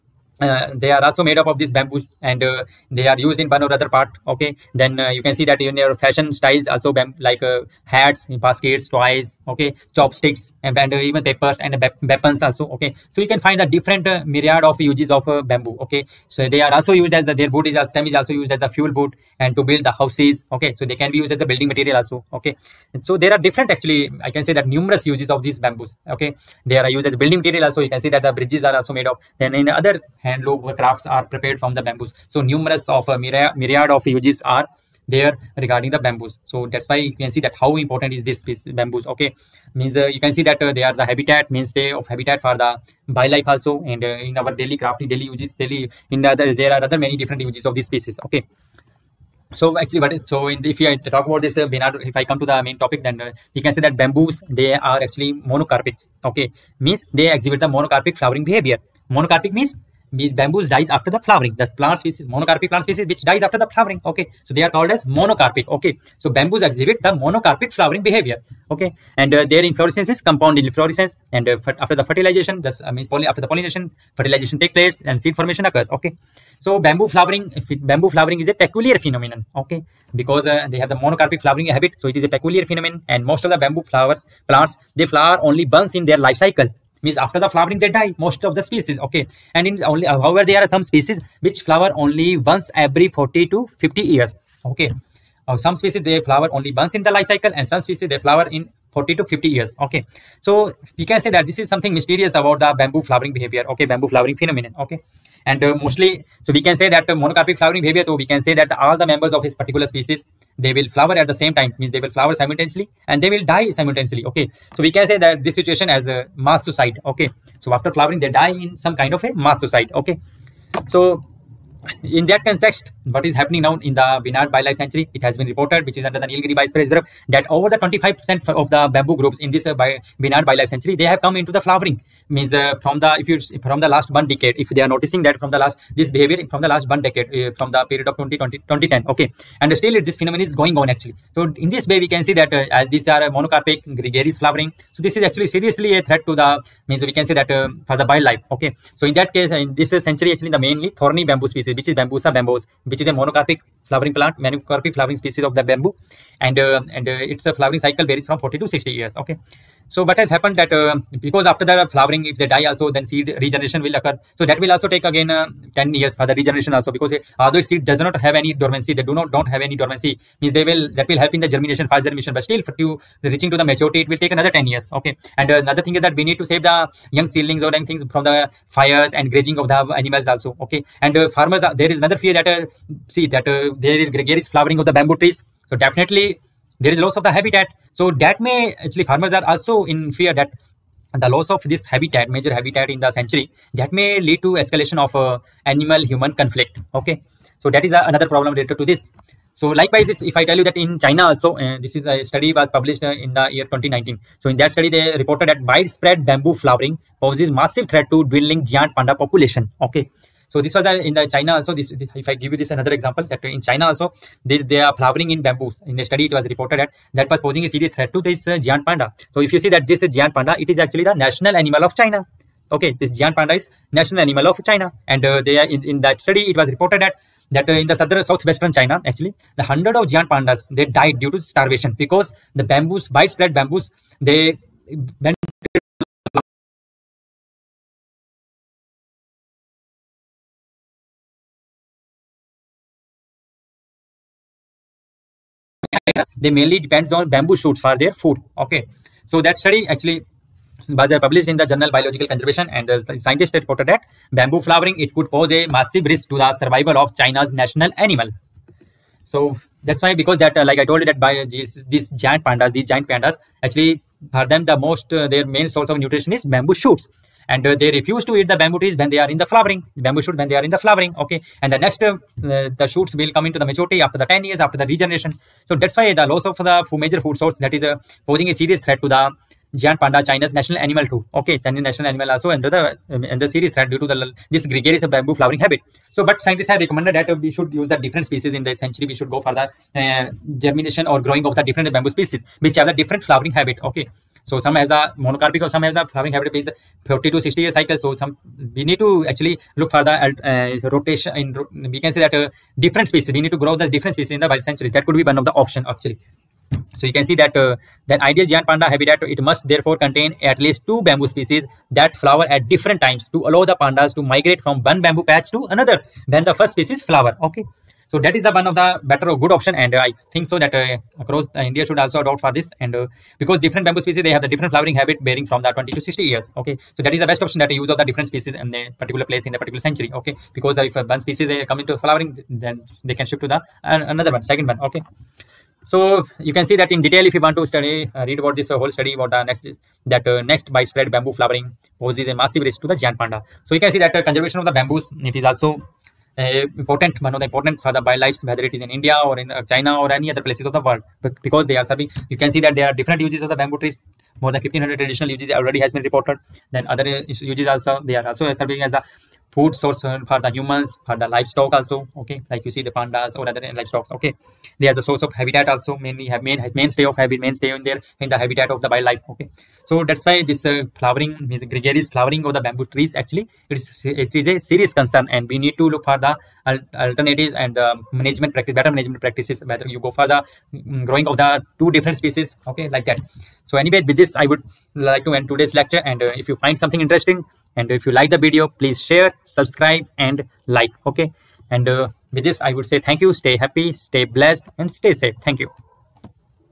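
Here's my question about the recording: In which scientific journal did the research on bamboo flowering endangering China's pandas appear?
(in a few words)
Biological Conservation.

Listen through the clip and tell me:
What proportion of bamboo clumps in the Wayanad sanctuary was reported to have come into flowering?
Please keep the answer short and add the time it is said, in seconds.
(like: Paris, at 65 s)
over 25%, at 127 s.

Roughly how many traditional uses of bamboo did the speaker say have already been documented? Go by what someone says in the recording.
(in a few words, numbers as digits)
more than 1500.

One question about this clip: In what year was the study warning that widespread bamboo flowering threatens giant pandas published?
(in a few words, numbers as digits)
2019.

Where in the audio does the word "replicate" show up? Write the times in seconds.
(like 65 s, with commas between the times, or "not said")
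not said.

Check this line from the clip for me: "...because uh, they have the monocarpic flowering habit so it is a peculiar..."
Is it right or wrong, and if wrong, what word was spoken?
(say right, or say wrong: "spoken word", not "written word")
right.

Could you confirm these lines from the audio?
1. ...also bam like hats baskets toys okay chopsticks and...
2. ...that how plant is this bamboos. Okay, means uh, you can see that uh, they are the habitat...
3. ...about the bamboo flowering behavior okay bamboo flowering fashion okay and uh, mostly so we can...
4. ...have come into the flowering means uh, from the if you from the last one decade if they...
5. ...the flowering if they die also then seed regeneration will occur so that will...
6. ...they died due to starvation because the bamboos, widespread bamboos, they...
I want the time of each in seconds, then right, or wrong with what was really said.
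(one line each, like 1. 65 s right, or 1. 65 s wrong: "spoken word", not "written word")
1. 6 s right
2. 37 s wrong: "important", not "plant"
3. 102 s wrong: "phenomenon", not "fashion"
4. 131 s right
5. 161 s right
6. 230 s right.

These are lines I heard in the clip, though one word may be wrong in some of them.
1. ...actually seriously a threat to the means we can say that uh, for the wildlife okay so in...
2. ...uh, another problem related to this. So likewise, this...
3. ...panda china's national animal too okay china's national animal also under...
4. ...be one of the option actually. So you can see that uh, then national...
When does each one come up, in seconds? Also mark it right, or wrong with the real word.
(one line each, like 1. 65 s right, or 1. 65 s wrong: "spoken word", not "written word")
1. 145 s right
2. 197 s right
3. 280 s right
4. 305 s wrong: "ideal", not "national".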